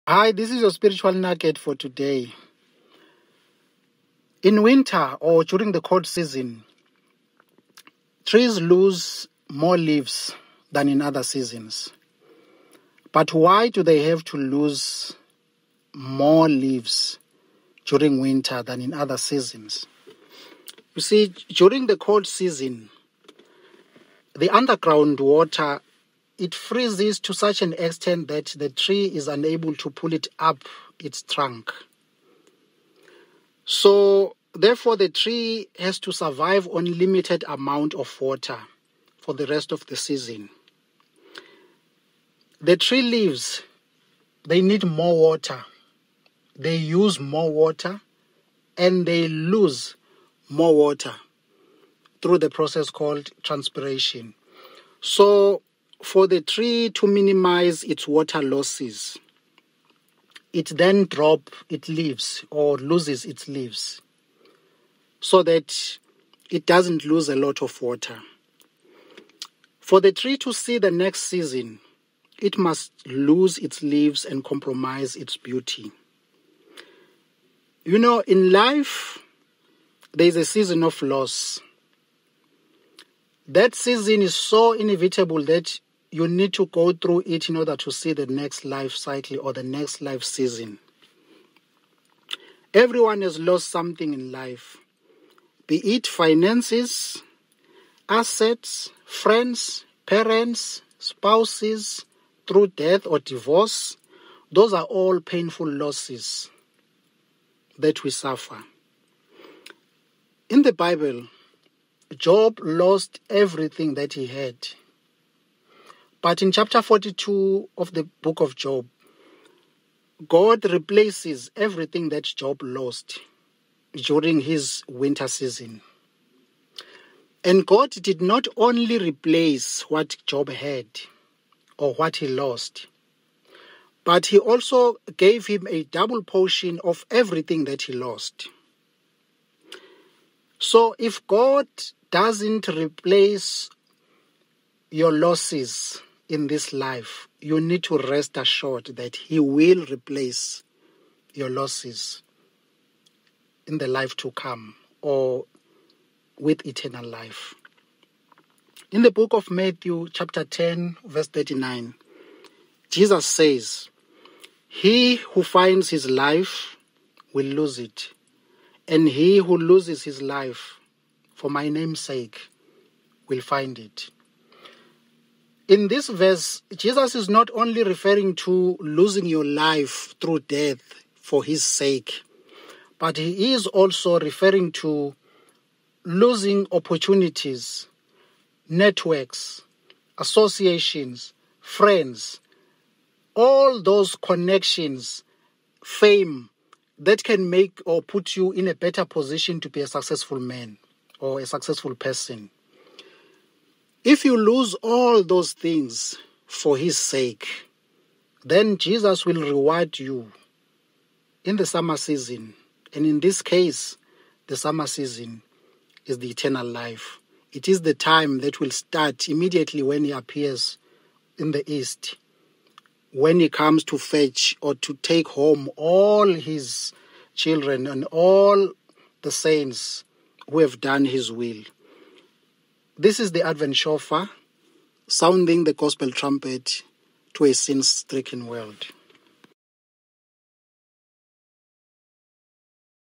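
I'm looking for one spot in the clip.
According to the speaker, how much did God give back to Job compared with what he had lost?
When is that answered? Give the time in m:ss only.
2:15.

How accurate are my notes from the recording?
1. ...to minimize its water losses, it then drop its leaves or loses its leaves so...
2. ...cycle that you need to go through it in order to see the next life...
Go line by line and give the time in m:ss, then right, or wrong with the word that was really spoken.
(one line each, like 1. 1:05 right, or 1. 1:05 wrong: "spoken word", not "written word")
1. 0:56 right
2. 1:24 wrong: "inevitable", not "cycle".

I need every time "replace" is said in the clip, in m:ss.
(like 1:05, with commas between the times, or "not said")
2:00, 2:08, 2:22, 2:29.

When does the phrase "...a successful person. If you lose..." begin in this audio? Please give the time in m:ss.
3:21.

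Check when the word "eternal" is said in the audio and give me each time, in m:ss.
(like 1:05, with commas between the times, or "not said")
2:36, 3:36.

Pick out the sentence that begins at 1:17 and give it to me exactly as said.
You know, in life, there is a season of loss.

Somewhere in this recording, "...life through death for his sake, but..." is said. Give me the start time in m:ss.
2:59.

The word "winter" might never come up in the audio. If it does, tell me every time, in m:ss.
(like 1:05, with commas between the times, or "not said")
0:04, 0:18, 2:04.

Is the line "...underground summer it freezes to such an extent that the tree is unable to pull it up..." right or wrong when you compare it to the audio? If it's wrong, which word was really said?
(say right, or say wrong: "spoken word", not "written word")
wrong: "water", not "summer".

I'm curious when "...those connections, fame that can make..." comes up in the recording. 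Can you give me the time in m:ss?
3:13.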